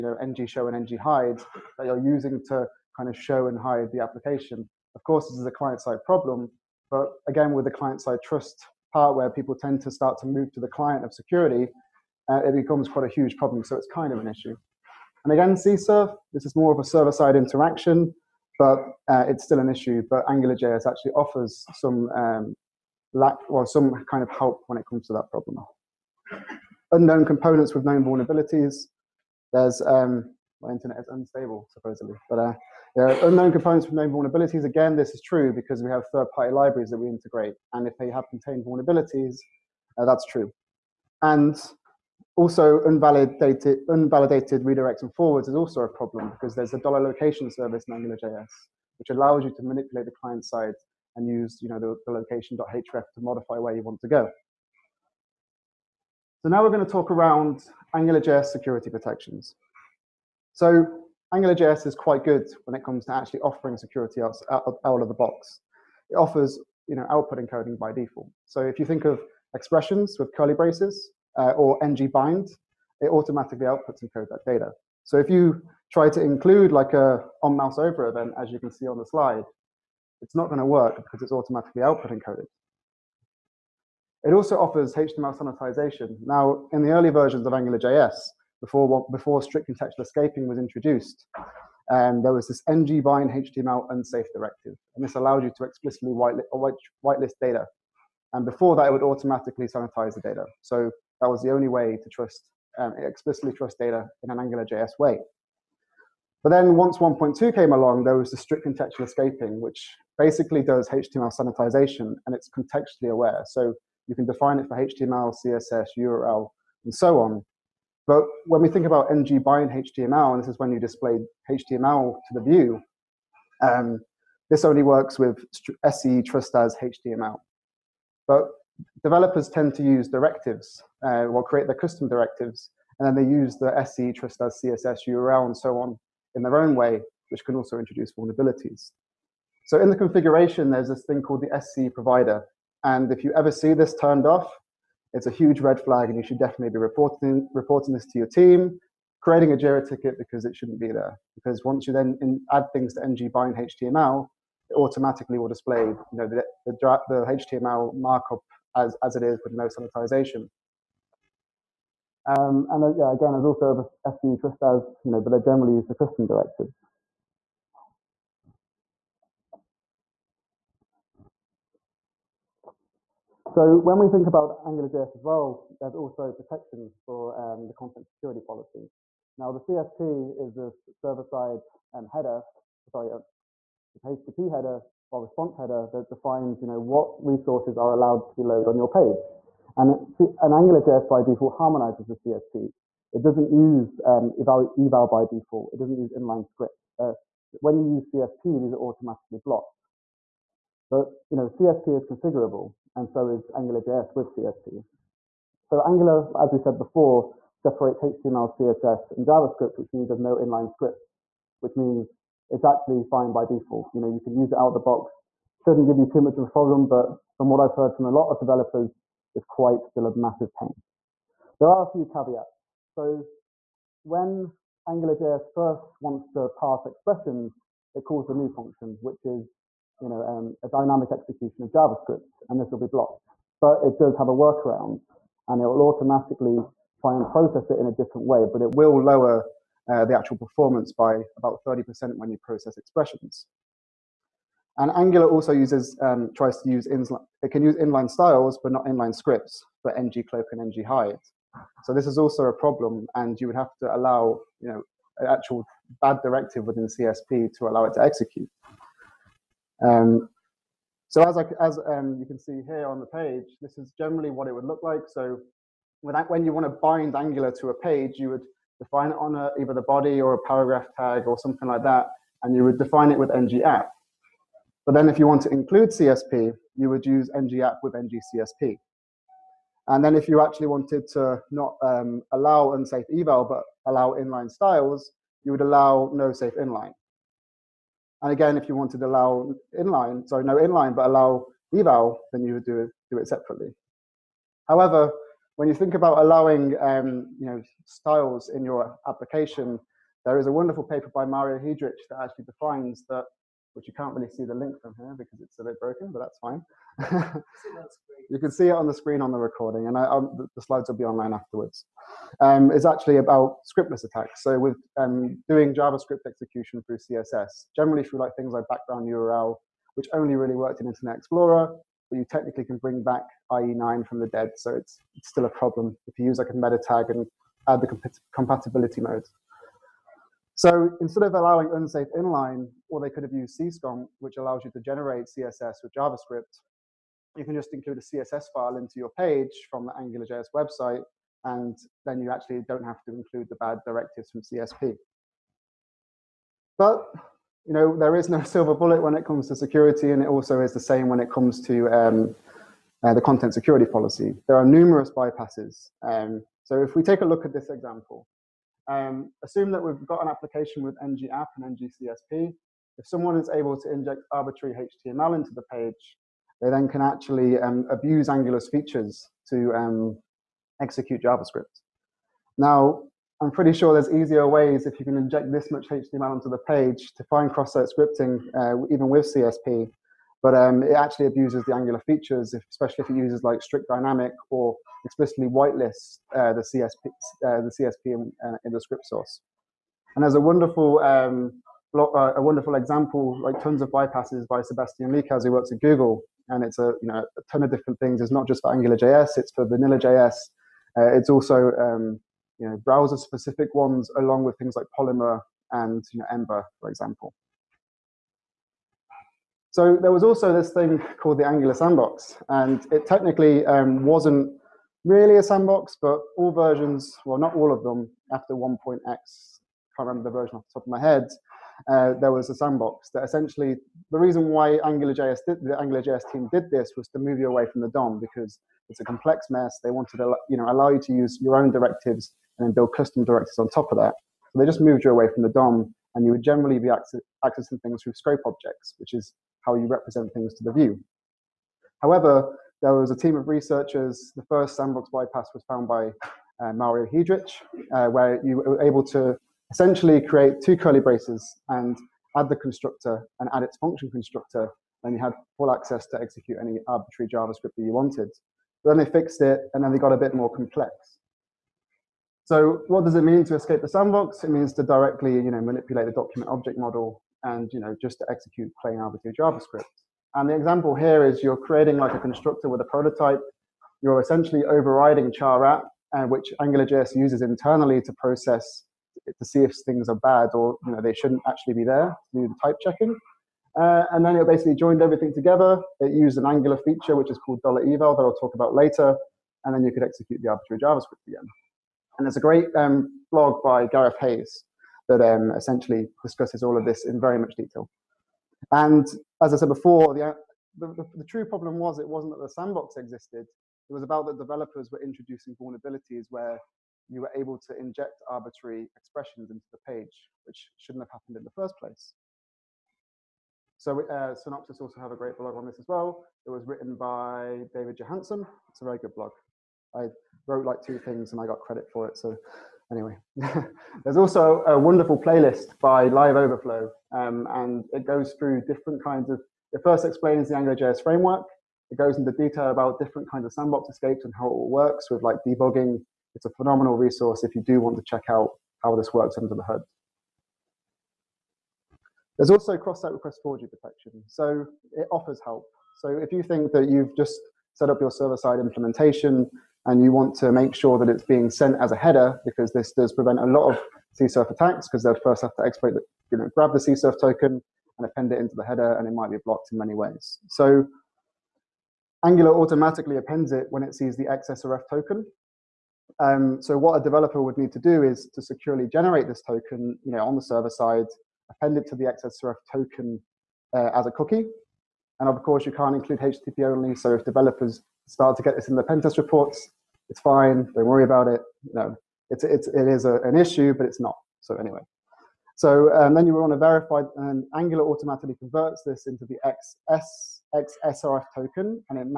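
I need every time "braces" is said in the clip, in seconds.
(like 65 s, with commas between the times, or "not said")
70 s, 450 s.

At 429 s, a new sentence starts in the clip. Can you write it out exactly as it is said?
They wanted to you know, allow you to use your own directives and then build custom directives on top of that.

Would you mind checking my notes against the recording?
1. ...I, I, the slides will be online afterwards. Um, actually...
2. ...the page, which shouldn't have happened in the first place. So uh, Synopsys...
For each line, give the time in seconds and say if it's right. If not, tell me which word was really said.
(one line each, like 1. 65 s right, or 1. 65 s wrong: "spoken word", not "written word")
1. 309 s right
2. 509 s right.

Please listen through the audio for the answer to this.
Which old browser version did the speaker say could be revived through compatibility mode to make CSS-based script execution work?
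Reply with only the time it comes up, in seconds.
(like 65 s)
323 s.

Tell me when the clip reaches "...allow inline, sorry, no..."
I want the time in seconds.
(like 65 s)
289 s.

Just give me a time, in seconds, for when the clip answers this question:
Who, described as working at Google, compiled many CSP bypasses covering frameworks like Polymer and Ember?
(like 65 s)
394 s.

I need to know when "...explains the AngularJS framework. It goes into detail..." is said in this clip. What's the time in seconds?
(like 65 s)
530 s.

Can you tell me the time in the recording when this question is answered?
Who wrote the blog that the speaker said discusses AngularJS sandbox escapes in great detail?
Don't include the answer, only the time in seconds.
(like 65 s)
493 s.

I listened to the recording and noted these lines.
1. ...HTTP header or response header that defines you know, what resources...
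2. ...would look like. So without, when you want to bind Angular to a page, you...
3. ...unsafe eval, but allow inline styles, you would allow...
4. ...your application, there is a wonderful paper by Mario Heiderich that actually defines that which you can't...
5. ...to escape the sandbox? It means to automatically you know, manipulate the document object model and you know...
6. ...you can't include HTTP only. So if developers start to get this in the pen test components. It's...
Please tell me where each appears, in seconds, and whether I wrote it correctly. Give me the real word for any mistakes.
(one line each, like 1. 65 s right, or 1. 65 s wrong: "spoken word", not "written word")
1. 184 s right
2. 264 s right
3. 282 s right
4. 298 s right
5. 463 s wrong: "directly", not "automatically"
6. 575 s wrong: "reports", not "components".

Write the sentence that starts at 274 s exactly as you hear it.
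But then if you want to include CSP, you would use ng-app with ng-CSP.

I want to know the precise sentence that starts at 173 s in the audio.
So when we think about AngularJS as well, there's also protections for um, the content security policy.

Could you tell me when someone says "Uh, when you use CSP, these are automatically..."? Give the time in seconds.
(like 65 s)
196 s.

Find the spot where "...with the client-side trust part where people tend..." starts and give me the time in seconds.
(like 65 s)
7 s.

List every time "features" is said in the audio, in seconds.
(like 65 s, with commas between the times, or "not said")
368 s, 382 s, 486 s.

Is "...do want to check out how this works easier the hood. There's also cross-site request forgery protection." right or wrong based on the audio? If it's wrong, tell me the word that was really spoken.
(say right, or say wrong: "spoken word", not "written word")
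wrong: "under", not "easier".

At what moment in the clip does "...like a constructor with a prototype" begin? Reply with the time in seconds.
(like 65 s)
471 s.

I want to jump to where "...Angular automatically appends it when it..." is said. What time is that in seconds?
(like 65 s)
562 s.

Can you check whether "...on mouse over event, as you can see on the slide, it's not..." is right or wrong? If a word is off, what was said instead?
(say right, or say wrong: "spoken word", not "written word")
right.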